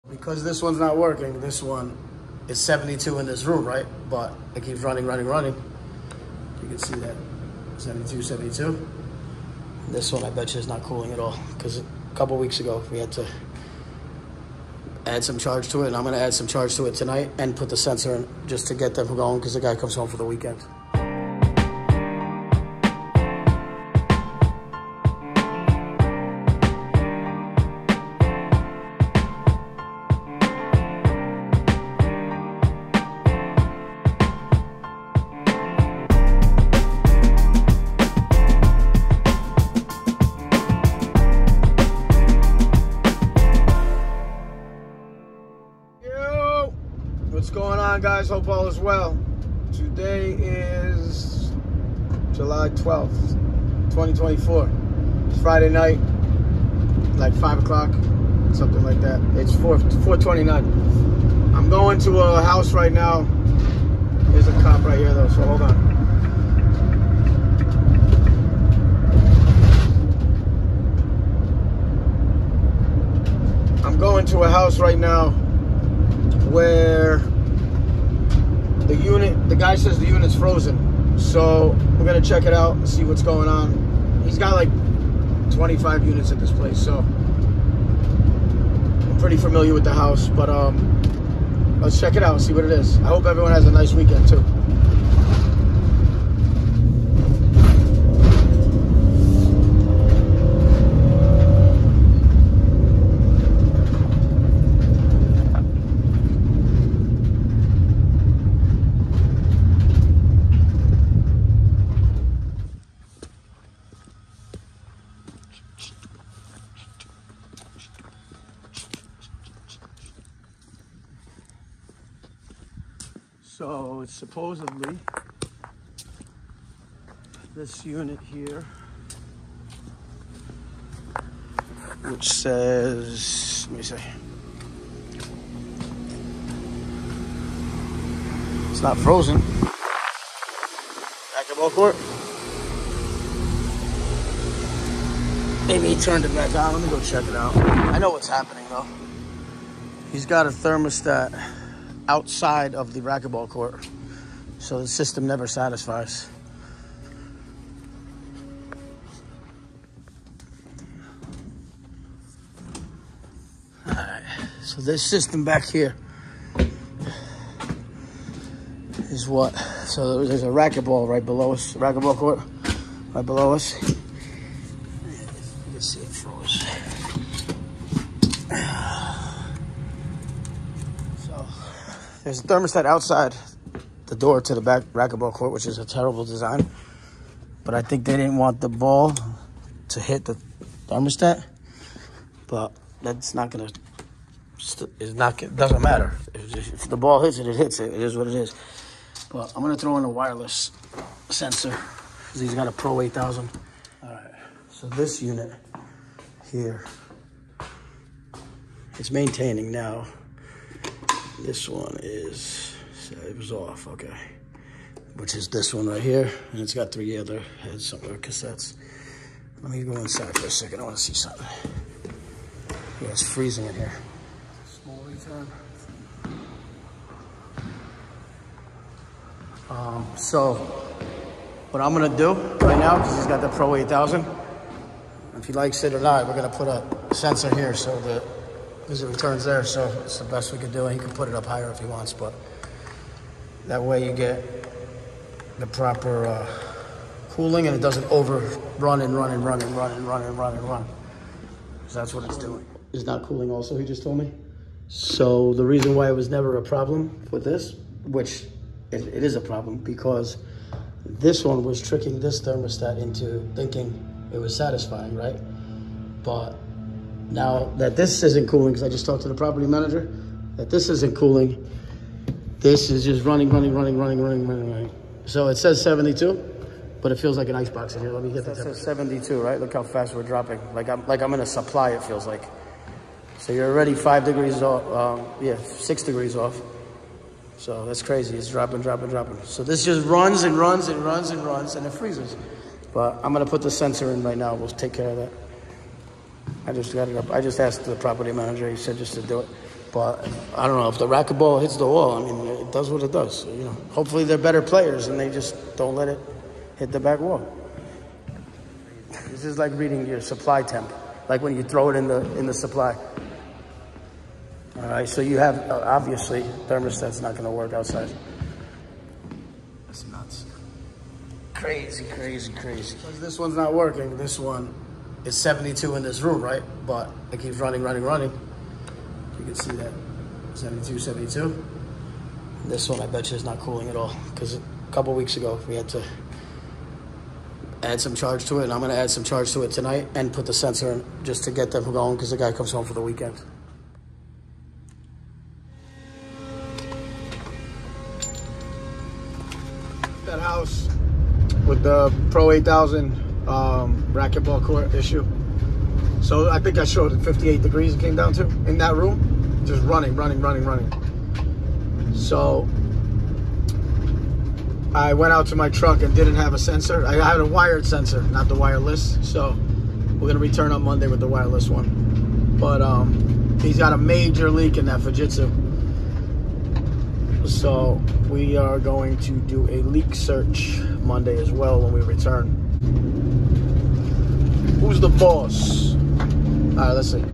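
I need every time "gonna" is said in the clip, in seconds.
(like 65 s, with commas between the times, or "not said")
16 s, 82 s, 193 s, 199 s, 293 s, 370 s.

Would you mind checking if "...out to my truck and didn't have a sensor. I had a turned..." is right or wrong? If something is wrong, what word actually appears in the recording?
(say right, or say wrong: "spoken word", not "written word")
wrong: "wired", not "turned".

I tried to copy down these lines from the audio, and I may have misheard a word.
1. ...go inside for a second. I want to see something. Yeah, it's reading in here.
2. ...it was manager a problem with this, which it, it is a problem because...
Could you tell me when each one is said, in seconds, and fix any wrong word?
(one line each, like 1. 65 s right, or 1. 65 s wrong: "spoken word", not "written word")
1. 219 s wrong: "freezing", not "reading"
2. 256 s wrong: "never", not "manager".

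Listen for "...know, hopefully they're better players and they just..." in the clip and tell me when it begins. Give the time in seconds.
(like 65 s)
303 s.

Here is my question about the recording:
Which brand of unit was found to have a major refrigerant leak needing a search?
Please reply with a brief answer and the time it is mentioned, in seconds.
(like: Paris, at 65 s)
Fujitsu, at 374 s.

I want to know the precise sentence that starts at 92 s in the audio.
I hope everyone has a nice weekend too.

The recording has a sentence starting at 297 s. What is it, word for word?
I just asked the property manager.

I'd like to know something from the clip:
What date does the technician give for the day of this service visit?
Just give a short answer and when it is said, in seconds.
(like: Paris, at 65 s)
July 12th, 2024, at 52 s.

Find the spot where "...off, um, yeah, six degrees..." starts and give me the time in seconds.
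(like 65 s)
284 s.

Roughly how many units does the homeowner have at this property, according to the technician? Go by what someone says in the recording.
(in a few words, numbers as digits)
25.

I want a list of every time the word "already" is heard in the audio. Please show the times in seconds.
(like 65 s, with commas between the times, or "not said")
283 s.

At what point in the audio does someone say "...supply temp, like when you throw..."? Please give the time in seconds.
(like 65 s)
310 s.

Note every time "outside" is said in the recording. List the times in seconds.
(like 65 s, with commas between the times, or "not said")
152 s, 182 s, 317 s.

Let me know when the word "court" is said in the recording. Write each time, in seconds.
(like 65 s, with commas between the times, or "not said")
141 s, 153 s, 172 s, 185 s, 354 s.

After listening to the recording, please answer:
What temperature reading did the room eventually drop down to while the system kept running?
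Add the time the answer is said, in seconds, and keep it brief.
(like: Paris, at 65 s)
58 degrees, at 357 s.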